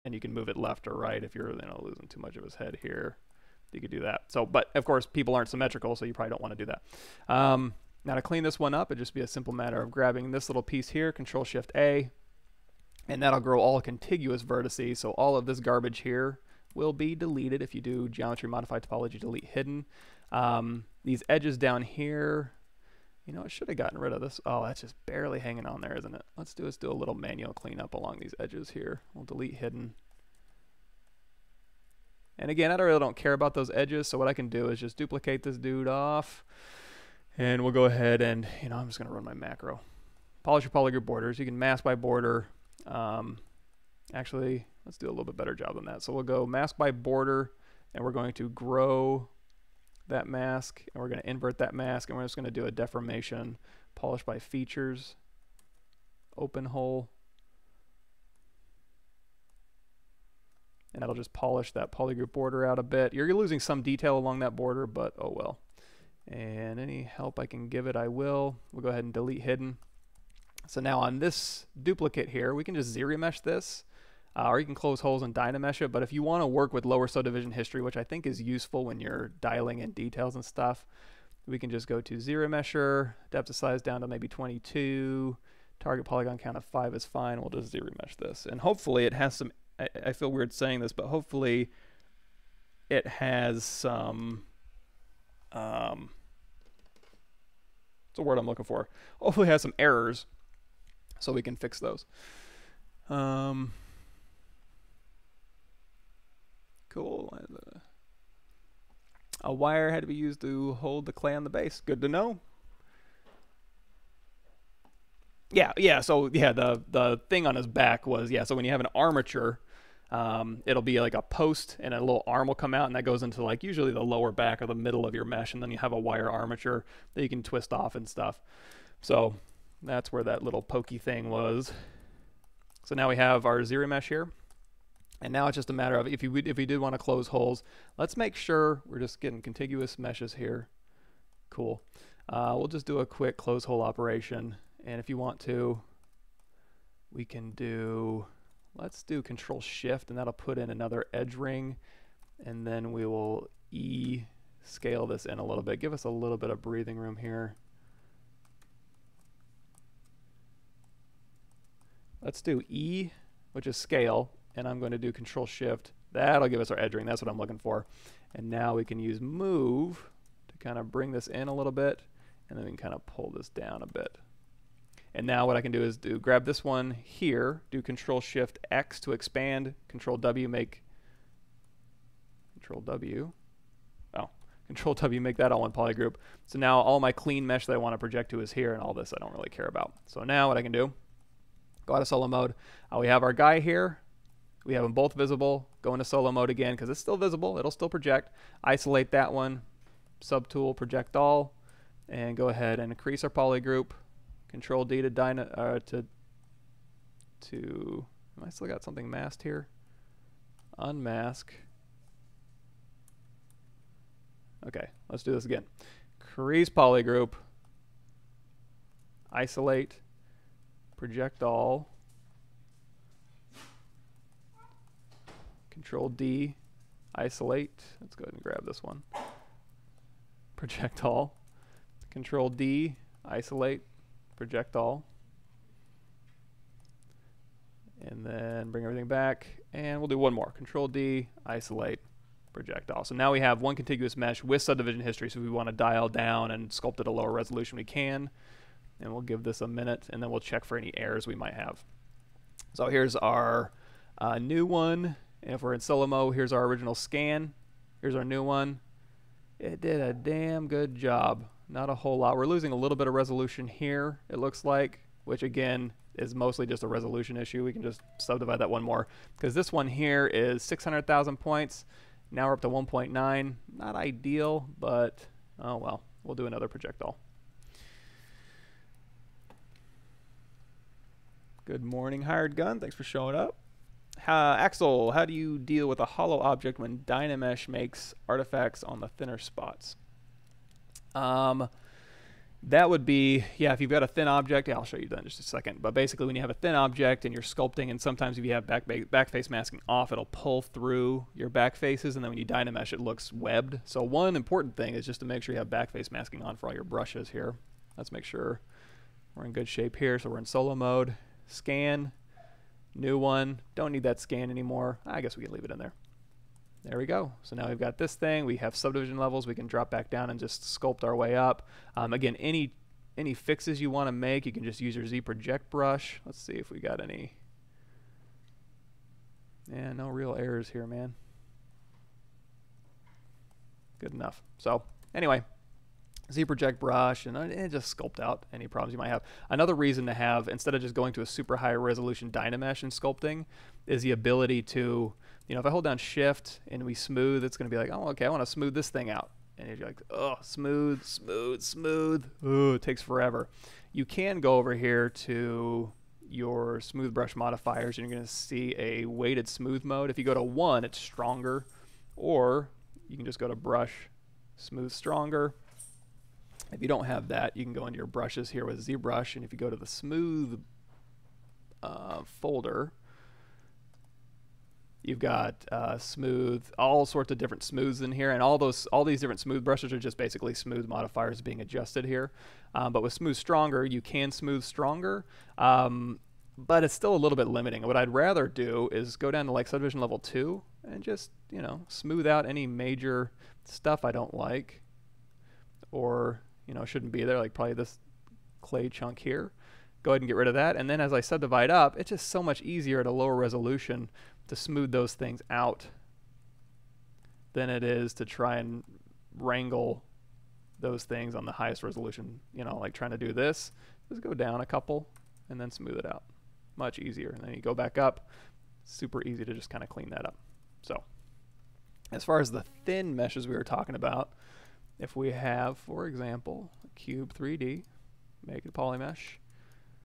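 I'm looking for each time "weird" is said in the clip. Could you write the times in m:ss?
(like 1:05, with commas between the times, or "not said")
1:30.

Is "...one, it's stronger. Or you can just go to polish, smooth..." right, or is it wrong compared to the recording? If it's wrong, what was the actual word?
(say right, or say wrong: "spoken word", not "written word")
wrong: "brush", not "polish".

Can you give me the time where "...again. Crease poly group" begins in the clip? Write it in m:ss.
3:35.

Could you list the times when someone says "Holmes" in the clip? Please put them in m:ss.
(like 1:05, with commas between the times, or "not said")
not said.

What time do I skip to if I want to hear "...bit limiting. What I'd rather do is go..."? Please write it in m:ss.
6:27.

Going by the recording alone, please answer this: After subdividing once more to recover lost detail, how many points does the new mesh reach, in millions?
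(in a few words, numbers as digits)
1.9.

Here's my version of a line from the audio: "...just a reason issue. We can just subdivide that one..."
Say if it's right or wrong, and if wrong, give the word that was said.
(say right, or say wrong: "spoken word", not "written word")
wrong: "resolution", not "reason".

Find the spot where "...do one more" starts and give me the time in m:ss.
4:00.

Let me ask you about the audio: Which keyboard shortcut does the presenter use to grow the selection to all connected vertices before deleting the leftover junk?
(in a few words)
Control Shift A.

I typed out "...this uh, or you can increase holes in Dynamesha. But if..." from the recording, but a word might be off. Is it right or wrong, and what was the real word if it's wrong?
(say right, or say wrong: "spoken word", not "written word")
wrong: "close", not "increase".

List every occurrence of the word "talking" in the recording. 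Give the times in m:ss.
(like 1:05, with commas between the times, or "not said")
7:03.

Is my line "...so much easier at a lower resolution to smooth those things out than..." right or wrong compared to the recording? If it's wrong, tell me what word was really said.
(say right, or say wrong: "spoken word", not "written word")
right.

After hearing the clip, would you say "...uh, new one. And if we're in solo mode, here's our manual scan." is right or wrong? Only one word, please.
wrong.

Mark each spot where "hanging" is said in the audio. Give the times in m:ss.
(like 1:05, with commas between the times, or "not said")
0:25.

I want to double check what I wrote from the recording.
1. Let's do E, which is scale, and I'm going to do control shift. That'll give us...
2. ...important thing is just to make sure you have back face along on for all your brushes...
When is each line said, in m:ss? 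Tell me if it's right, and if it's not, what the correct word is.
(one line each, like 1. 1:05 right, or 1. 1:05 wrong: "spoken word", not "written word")
1. 2:42 right
2. 5:04 wrong: "masking", not "along".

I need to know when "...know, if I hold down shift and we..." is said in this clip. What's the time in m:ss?
5:45.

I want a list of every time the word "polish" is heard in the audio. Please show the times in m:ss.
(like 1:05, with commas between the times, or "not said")
0:40, 0:53, 1:01.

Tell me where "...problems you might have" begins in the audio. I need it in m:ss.
5:38.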